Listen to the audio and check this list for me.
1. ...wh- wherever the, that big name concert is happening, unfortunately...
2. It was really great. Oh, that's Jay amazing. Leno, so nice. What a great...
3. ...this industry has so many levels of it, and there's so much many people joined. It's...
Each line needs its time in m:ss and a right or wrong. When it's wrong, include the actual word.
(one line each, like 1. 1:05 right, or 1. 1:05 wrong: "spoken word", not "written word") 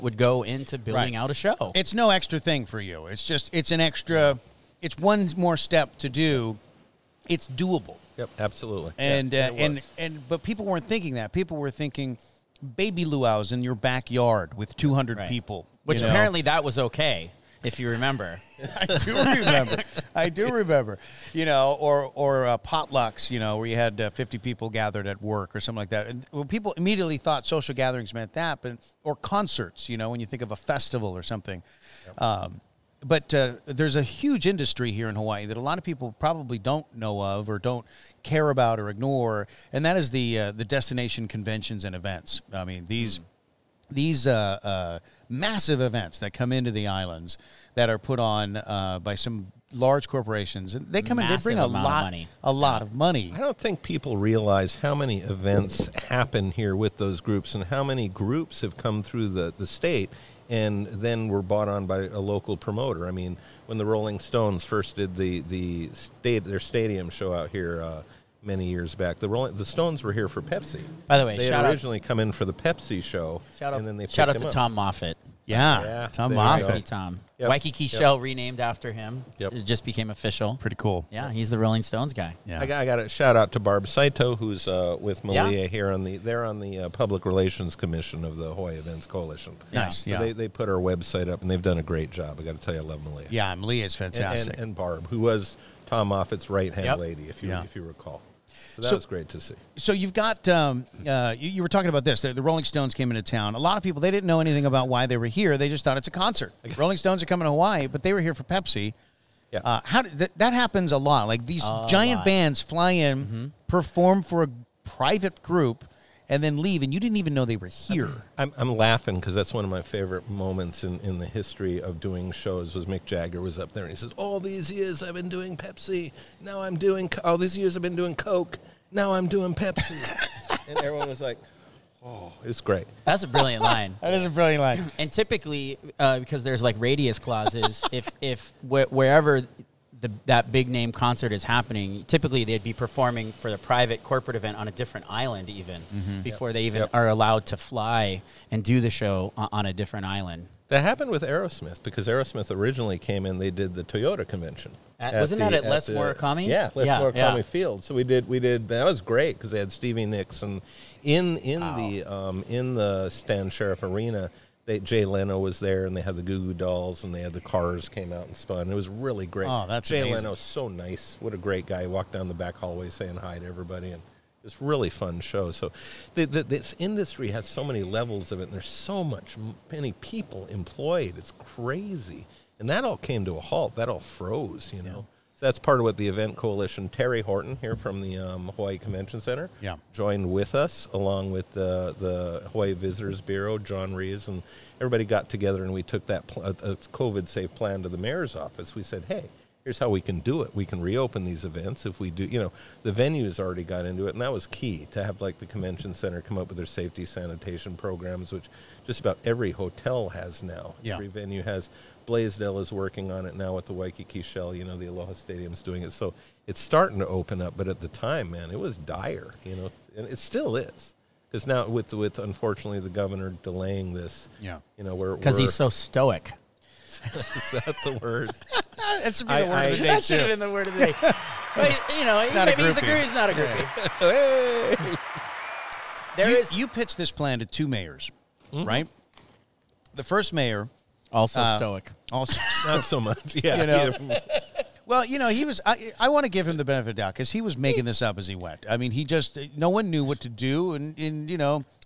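1. 2:18 wrong: "typically", not "unfortunately"
2. 2:48 right
3. 2:56 wrong: "employed", not "joined".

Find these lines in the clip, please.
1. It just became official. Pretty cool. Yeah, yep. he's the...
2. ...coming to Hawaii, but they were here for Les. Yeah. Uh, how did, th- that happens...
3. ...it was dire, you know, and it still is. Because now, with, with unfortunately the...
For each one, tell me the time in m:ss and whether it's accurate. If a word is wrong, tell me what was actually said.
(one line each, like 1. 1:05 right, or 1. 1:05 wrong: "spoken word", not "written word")
1. 1:19 right
2. 1:47 wrong: "Pepsi", not "Les"
3. 3:38 right.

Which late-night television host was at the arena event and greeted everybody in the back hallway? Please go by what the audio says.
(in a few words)
Jay Leno.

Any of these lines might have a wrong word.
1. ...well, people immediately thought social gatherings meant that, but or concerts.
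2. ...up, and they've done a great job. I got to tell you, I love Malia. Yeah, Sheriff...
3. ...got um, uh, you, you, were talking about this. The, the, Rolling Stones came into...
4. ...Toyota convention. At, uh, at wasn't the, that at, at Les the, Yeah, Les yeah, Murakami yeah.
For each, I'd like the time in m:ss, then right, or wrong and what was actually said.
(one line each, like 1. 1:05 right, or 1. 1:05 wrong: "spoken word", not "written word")
1. 0:26 right
2. 1:31 wrong: "Malia", not "Sheriff"
3. 1:40 right
4. 2:33 right.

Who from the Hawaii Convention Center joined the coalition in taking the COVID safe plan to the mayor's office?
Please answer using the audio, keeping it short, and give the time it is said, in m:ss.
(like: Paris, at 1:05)
Teri Orton, at 3:06.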